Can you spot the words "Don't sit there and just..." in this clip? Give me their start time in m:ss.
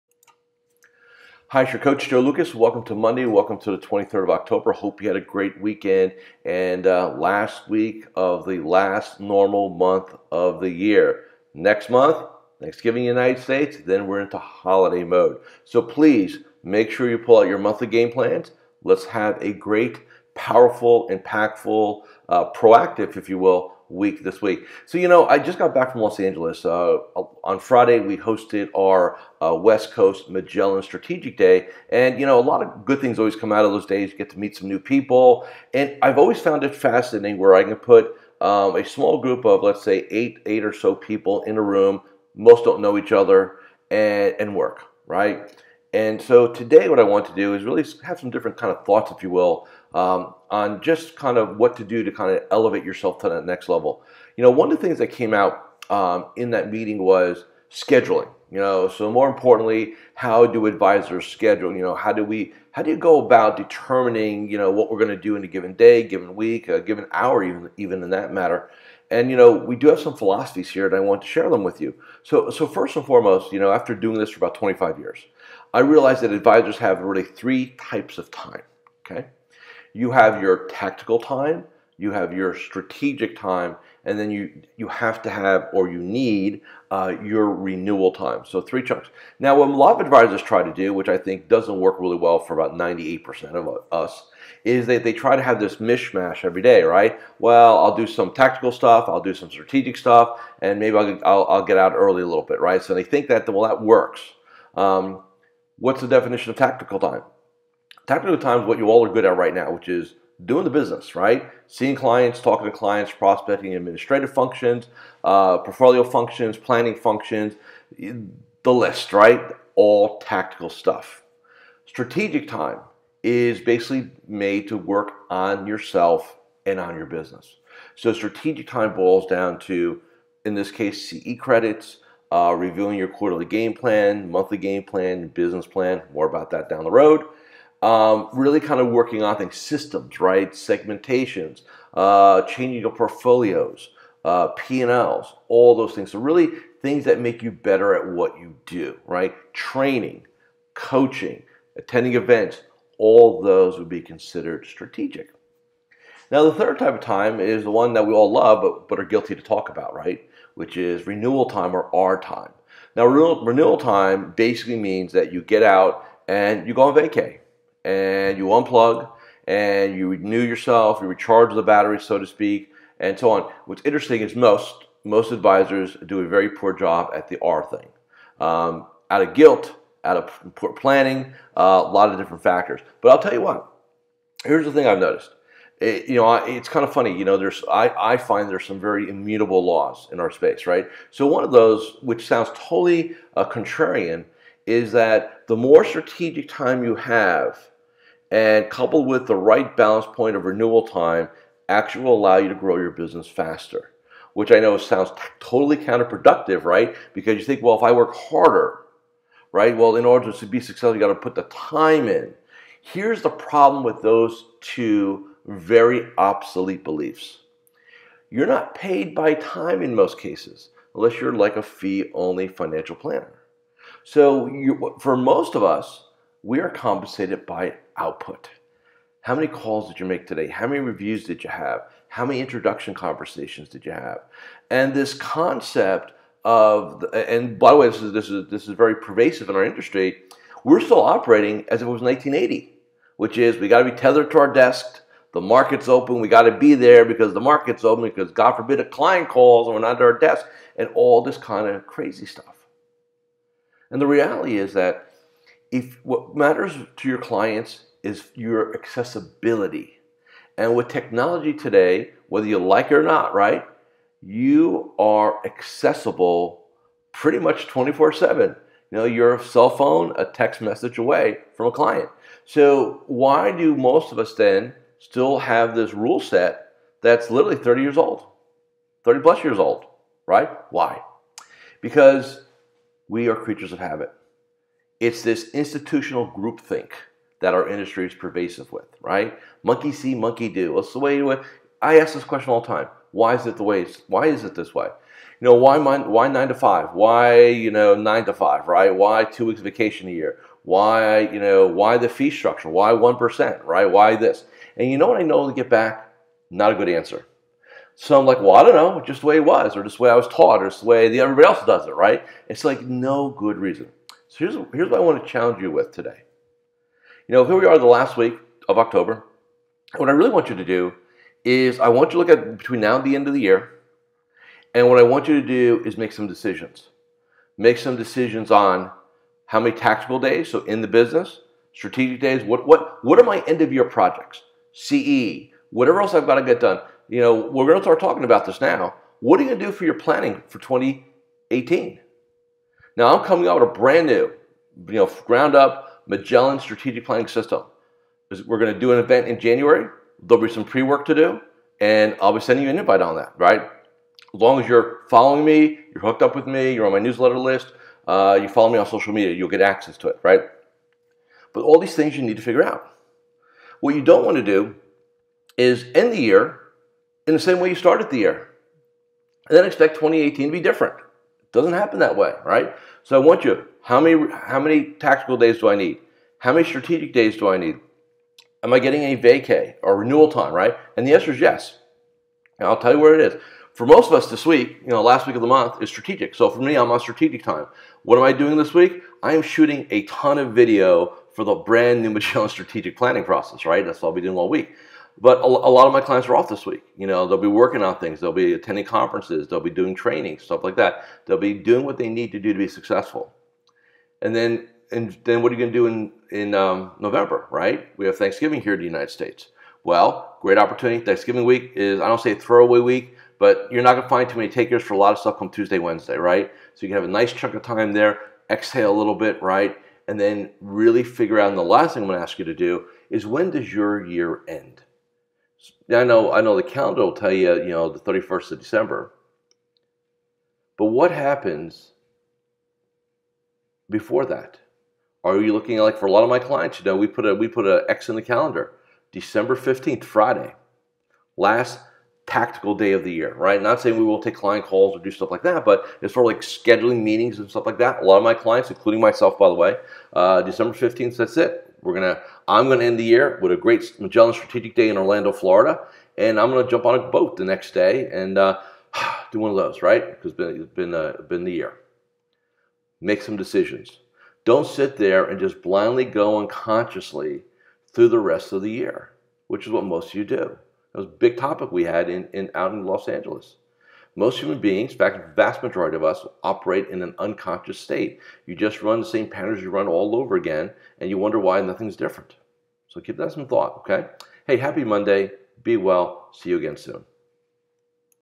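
7:44.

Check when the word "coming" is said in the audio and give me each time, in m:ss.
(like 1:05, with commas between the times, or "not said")
5:43.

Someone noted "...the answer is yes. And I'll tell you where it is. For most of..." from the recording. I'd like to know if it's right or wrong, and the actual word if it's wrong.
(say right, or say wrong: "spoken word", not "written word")
right.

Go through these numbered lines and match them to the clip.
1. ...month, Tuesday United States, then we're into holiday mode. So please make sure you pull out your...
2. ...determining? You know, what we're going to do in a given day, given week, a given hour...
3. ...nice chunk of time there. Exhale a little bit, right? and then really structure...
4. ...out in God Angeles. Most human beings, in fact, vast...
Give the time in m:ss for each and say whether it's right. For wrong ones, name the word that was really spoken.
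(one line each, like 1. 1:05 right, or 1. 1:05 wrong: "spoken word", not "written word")
1. 0:11 wrong: "Thanksgiving", not "Tuesday"
2. 1:03 right
3. 6:57 wrong: "figure", not "structure"
4. 7:52 wrong: "Los", not "God".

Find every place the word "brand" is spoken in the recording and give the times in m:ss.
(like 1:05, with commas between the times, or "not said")
5:43, 6:31.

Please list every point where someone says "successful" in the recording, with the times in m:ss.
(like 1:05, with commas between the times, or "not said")
3:30, 6:42.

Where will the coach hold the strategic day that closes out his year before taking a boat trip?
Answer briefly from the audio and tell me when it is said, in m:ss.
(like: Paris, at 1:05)
Orlando, Florida, at 7:34.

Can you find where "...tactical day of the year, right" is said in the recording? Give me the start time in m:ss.
7:22.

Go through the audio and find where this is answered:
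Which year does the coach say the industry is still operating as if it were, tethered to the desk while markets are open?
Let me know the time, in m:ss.
4:02.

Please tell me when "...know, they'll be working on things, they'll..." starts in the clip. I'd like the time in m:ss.
6:37.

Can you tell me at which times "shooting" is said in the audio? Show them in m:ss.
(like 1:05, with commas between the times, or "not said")
6:29.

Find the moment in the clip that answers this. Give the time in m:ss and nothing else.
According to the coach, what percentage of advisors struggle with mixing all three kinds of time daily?
1:32.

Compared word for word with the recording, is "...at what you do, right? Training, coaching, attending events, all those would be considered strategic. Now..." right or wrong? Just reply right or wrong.
right.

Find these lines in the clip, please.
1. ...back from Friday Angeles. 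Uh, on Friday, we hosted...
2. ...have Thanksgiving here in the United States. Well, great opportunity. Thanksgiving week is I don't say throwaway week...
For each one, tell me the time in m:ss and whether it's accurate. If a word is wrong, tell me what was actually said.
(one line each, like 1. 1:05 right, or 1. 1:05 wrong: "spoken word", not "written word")
1. 0:25 wrong: "Los", not "Friday"
2. 6:48 right.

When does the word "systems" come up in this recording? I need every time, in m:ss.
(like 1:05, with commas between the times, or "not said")
2:19, 5:47.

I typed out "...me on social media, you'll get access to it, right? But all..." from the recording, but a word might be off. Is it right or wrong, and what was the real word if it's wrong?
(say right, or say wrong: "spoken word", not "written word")
right.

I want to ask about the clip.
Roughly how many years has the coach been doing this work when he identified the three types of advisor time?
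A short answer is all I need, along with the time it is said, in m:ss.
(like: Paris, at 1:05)
25, at 1:14.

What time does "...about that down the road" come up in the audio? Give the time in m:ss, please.
2:16.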